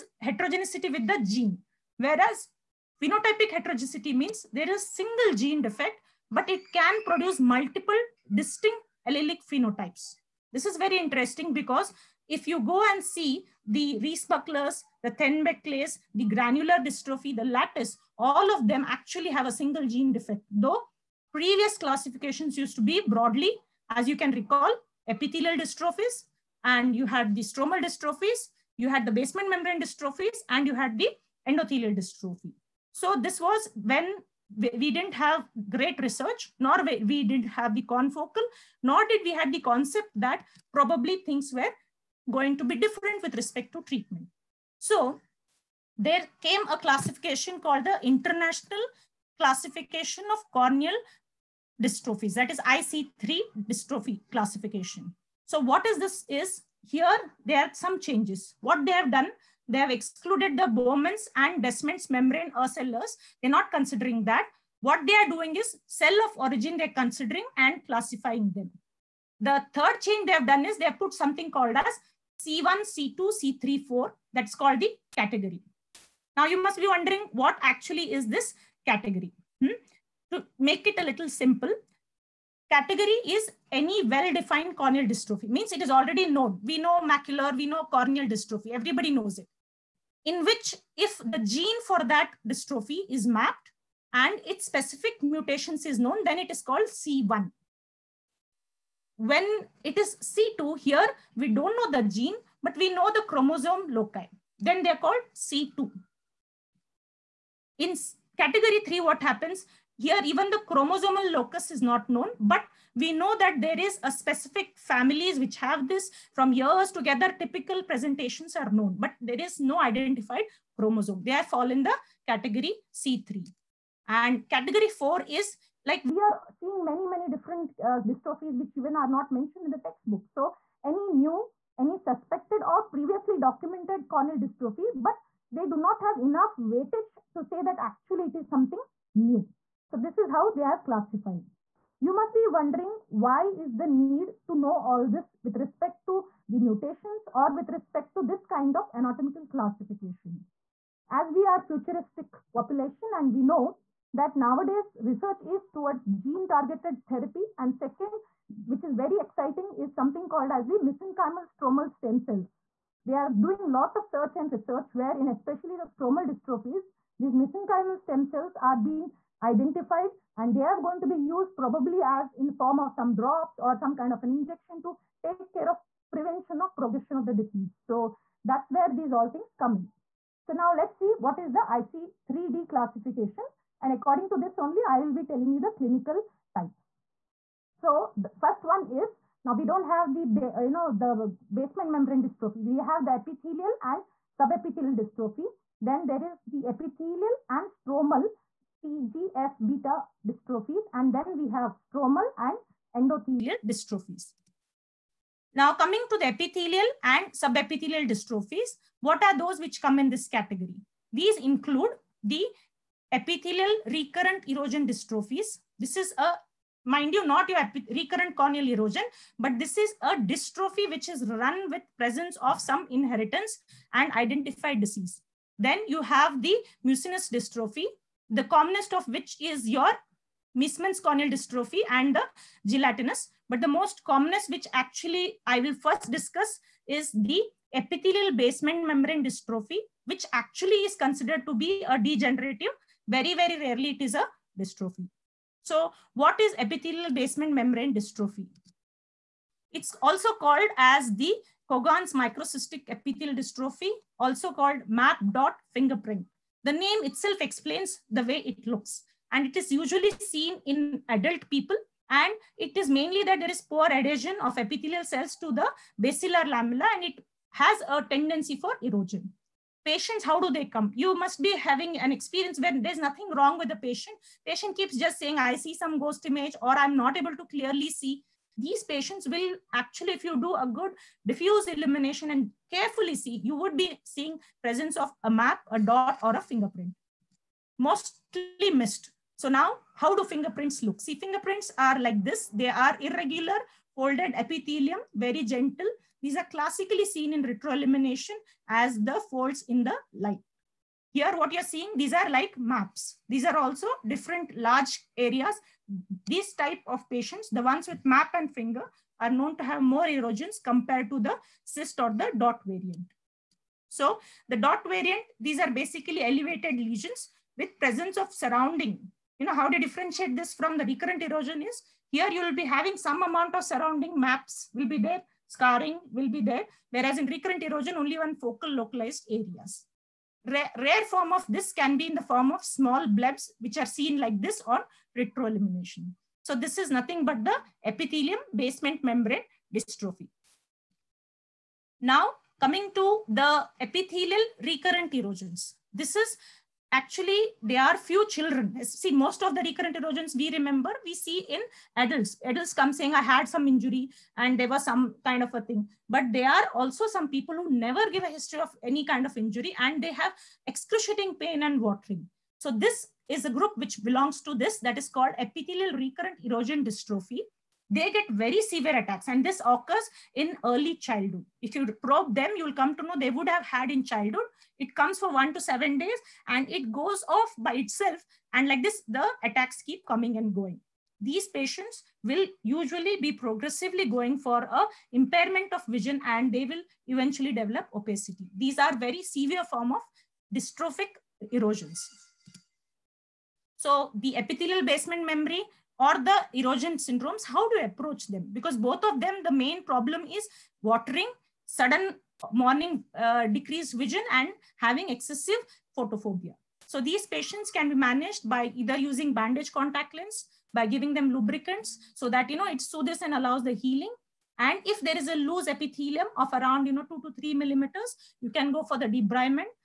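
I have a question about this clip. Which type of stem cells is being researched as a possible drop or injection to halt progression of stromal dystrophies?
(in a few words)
mesenchymal stromal stem cells.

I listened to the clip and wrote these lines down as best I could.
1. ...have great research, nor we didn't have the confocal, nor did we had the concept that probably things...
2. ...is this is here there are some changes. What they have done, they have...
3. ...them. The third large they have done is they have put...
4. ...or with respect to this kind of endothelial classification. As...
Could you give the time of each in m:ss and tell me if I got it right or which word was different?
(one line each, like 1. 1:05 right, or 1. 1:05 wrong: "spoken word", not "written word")
1. 0:35 right
2. 0:55 right
3. 1:08 wrong: "change", not "large"
4. 2:27 wrong: "anatomical", not "endothelial".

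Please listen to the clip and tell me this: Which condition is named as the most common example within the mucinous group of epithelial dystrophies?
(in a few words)
Meesmann's corneal dystrophy.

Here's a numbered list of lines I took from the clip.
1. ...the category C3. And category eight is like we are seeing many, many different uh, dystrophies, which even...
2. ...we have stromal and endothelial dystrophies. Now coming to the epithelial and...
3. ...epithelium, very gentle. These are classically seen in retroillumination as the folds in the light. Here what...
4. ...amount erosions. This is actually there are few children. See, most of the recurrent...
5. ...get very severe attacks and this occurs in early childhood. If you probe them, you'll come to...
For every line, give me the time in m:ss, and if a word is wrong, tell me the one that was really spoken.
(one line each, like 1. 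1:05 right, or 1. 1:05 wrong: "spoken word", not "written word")
1. 2:01 wrong: "four", not "eight"
2. 3:21 right
3. 4:54 right
4. 5:44 wrong: "recurrent", not "amount"
5. 6:08 right.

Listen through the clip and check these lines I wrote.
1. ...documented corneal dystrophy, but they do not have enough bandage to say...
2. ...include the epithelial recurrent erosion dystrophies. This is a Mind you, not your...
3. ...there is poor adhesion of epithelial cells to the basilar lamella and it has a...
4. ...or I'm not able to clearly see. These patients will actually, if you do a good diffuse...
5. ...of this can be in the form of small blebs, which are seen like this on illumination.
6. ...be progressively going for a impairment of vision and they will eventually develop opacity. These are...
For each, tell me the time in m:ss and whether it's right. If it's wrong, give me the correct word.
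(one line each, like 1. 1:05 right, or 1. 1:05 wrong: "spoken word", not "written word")
1. 2:13 wrong: "weightage", not "bandage"
2. 3:31 right
3. 4:23 right
4. 4:36 right
5. 5:31 wrong: "retroillumination", not "illumination"
6. 6:23 right.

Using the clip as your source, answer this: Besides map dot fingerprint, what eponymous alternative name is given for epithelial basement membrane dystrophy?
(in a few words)
Cogan's microcystic epithelial dystrophy.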